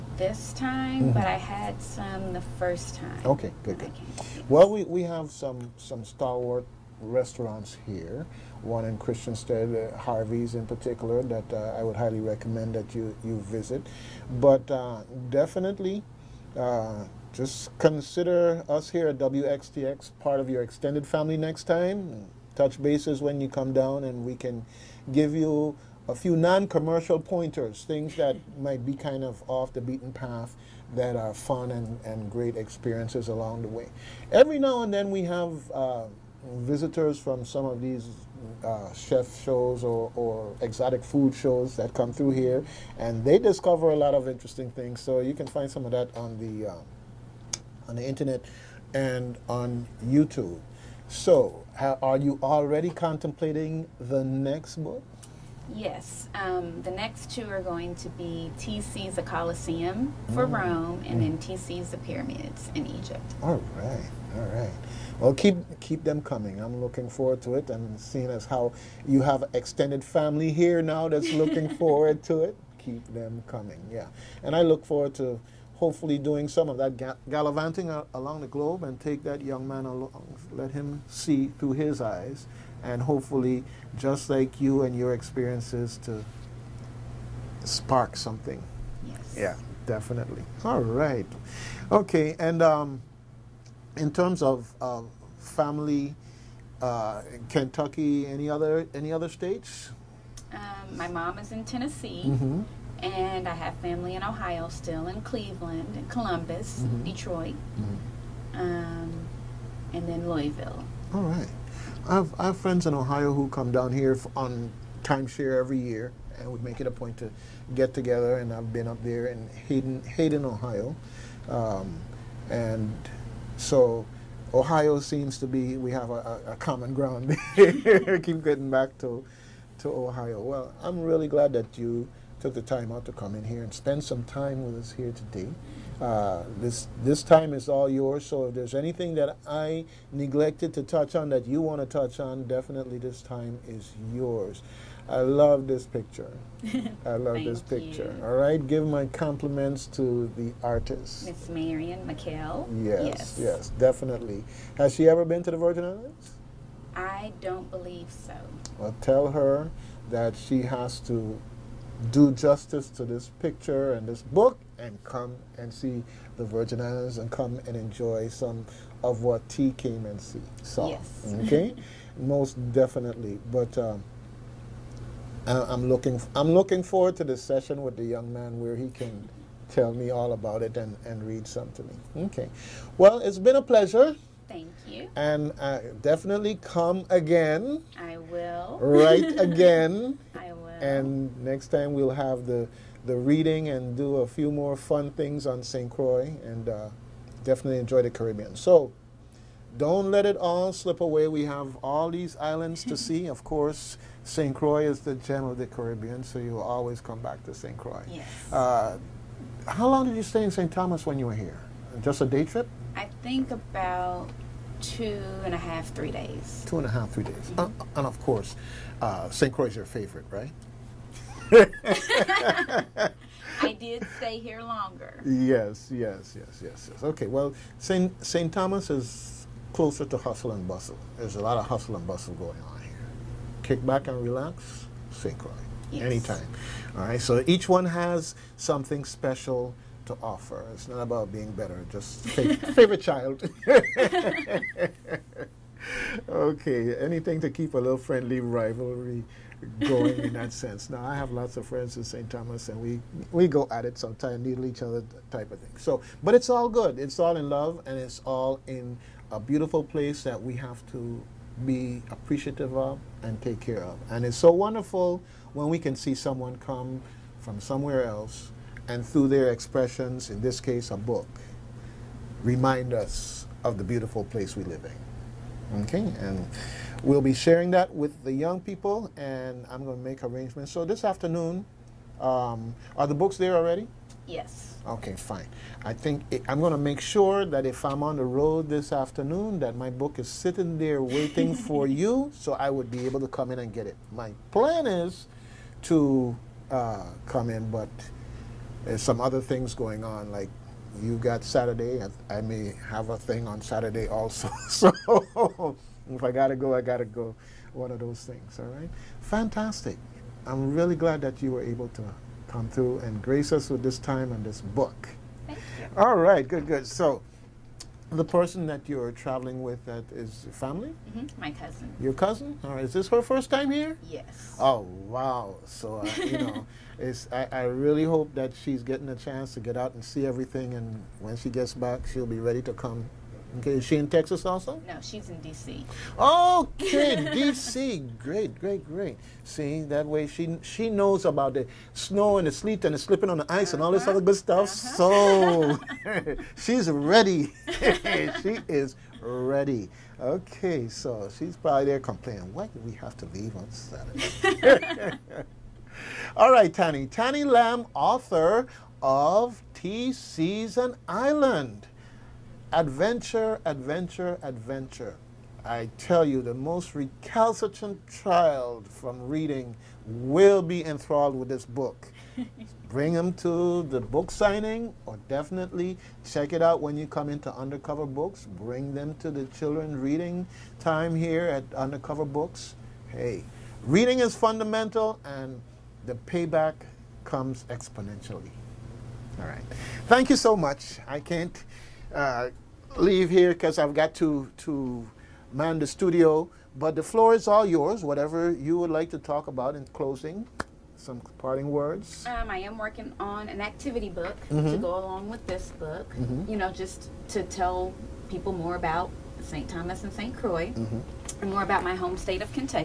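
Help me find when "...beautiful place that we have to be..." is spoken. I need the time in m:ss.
4:19.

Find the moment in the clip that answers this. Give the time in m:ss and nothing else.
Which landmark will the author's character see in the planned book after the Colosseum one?
1:01.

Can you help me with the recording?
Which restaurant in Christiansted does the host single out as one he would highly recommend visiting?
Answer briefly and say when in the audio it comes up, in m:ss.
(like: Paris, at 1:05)
Harvey's, at 0:09.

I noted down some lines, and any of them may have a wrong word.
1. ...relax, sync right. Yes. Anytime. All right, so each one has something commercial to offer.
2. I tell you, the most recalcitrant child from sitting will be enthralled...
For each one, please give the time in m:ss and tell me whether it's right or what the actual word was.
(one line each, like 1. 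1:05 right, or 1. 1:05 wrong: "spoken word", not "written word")
1. 3:54 wrong: "special", not "commercial"
2. 6:05 wrong: "reading", not "sitting".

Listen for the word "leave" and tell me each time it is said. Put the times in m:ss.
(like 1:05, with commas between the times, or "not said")
5:53, 6:32.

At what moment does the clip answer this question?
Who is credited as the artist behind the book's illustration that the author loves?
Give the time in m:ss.
2:31.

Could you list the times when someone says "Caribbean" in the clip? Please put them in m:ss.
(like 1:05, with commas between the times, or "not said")
3:18, 3:25.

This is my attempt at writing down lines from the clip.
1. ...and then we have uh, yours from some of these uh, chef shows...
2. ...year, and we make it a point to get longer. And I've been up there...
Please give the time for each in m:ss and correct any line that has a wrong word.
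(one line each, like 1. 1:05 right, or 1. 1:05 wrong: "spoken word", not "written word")
1. 0:34 wrong: "visitors", not "yours"
2. 1:55 wrong: "together", not "longer".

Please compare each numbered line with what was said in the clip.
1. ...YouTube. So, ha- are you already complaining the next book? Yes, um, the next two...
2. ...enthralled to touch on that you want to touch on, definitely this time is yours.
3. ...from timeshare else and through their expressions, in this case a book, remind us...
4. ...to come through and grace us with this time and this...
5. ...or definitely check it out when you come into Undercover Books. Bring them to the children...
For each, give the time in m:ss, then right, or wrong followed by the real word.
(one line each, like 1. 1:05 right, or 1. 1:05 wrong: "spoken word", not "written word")
1. 0:50 wrong: "contemplating", not "complaining"
2. 2:20 wrong: "neglected", not "enthralled"
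3. 4:27 wrong: "somewhere", not "timeshare"
4. 5:11 right
5. 6:15 right.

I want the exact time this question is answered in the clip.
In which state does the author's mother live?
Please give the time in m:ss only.
1:41.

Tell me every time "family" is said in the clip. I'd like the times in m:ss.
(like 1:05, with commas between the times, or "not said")
0:21, 1:10, 1:35, 1:43, 5:20.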